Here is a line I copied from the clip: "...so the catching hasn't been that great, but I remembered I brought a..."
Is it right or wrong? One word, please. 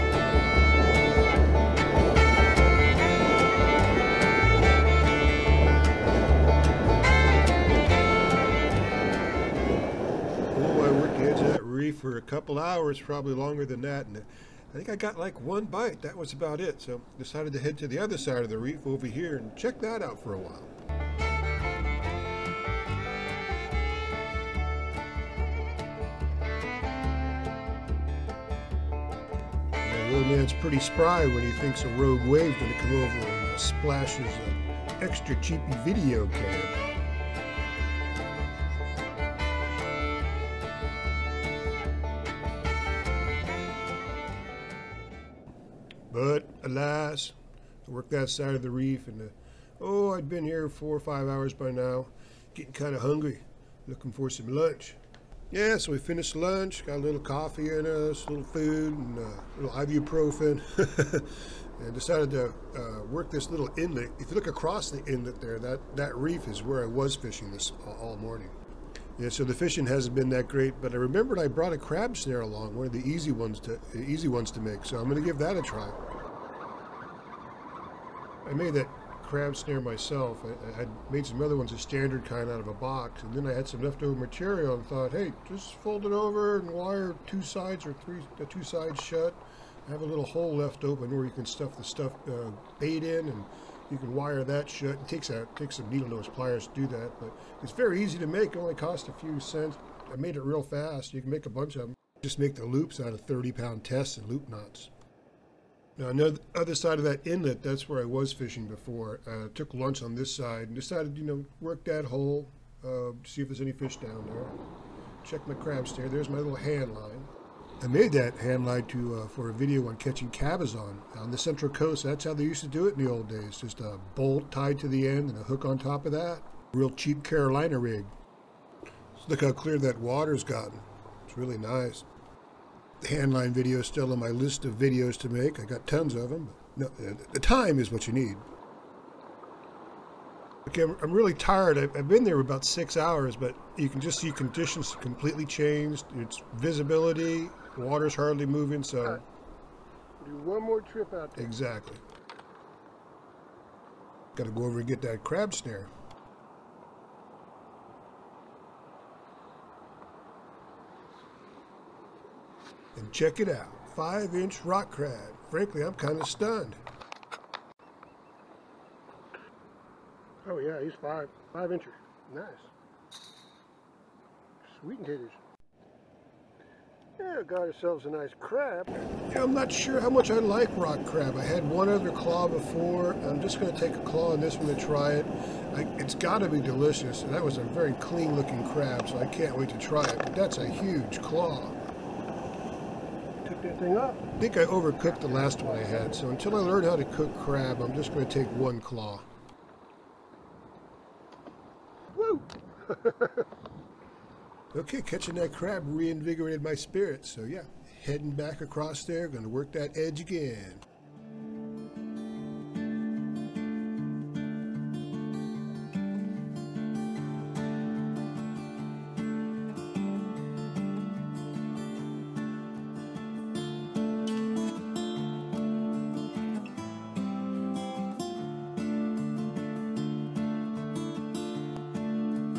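wrong.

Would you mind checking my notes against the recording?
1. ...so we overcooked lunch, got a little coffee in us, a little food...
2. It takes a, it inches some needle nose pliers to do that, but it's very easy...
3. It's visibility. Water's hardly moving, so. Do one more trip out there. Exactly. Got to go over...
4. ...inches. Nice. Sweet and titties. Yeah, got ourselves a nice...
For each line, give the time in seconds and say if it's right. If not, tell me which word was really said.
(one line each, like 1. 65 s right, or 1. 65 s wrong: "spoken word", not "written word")
1. 55 s wrong: "finished", not "overcooked"
2. 94 s wrong: "takes", not "inches"
3. 146 s right
4. 171 s right.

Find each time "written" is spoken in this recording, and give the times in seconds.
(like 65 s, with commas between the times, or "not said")
not said.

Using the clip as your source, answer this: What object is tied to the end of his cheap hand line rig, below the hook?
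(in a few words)
A bolt.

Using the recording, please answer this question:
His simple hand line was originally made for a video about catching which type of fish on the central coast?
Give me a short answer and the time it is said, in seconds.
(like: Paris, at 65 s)
Cabezon, at 120 s.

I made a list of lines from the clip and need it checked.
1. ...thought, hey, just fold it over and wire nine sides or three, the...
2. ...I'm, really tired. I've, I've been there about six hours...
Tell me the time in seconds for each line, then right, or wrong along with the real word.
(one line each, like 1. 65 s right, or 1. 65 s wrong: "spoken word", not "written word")
1. 84 s wrong: "two", not "nine"
2. 140 s right.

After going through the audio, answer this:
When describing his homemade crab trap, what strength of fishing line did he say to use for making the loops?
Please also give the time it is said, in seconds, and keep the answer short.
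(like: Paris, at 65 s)
30 pound test, at 103 s.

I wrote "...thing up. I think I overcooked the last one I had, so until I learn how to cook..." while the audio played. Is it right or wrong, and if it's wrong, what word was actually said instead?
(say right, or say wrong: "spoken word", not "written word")
right.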